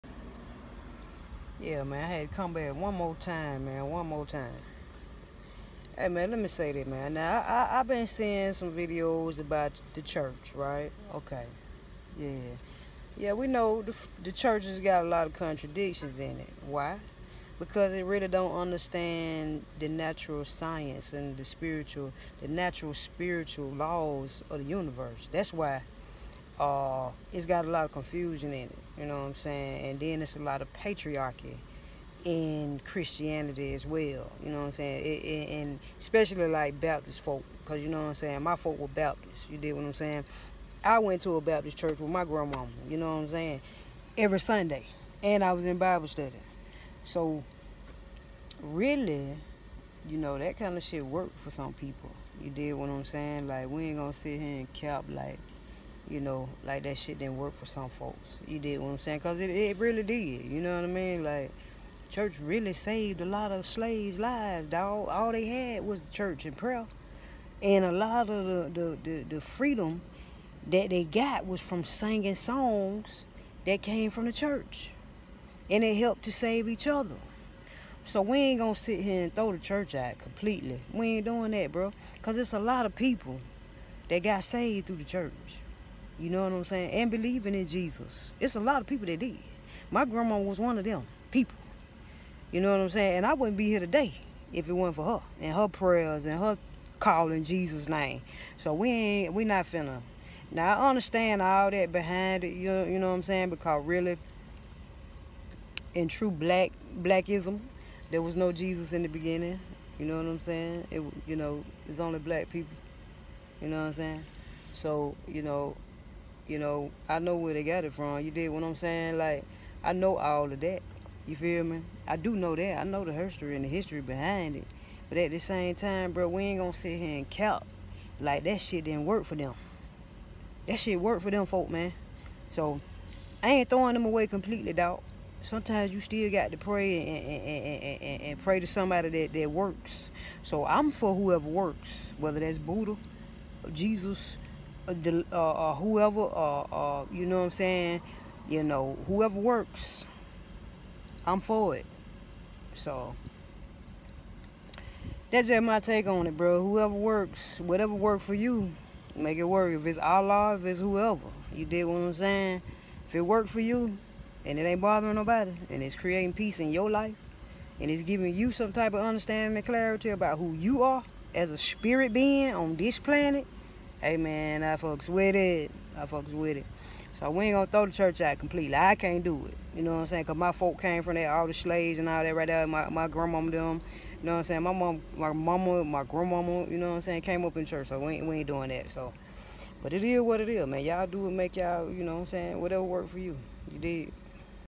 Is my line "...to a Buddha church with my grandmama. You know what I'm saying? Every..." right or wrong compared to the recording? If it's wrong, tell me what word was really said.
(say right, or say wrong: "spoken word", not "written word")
wrong: "Baptist", not "Buddha".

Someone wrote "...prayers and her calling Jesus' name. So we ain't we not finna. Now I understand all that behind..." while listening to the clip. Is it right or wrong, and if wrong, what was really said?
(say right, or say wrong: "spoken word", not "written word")
right.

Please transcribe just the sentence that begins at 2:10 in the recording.
That shit worked for them folk, man.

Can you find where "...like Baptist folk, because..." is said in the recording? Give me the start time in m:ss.
0:36.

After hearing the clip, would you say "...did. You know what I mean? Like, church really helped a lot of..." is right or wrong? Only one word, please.
wrong.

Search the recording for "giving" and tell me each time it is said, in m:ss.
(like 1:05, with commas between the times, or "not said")
2:48.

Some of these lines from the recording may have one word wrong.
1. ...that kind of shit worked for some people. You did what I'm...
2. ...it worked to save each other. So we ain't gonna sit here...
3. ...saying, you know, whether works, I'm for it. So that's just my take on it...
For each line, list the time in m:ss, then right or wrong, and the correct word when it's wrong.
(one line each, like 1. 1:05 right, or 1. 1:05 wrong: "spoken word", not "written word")
1. 0:50 right
2. 1:15 wrong: "helped", not "worked"
3. 2:27 wrong: "whoever", not "whether".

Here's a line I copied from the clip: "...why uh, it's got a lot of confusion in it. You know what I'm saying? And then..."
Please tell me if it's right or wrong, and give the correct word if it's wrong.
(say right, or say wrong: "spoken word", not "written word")
right.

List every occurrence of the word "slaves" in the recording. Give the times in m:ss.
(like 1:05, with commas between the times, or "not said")
1:03, 3:01.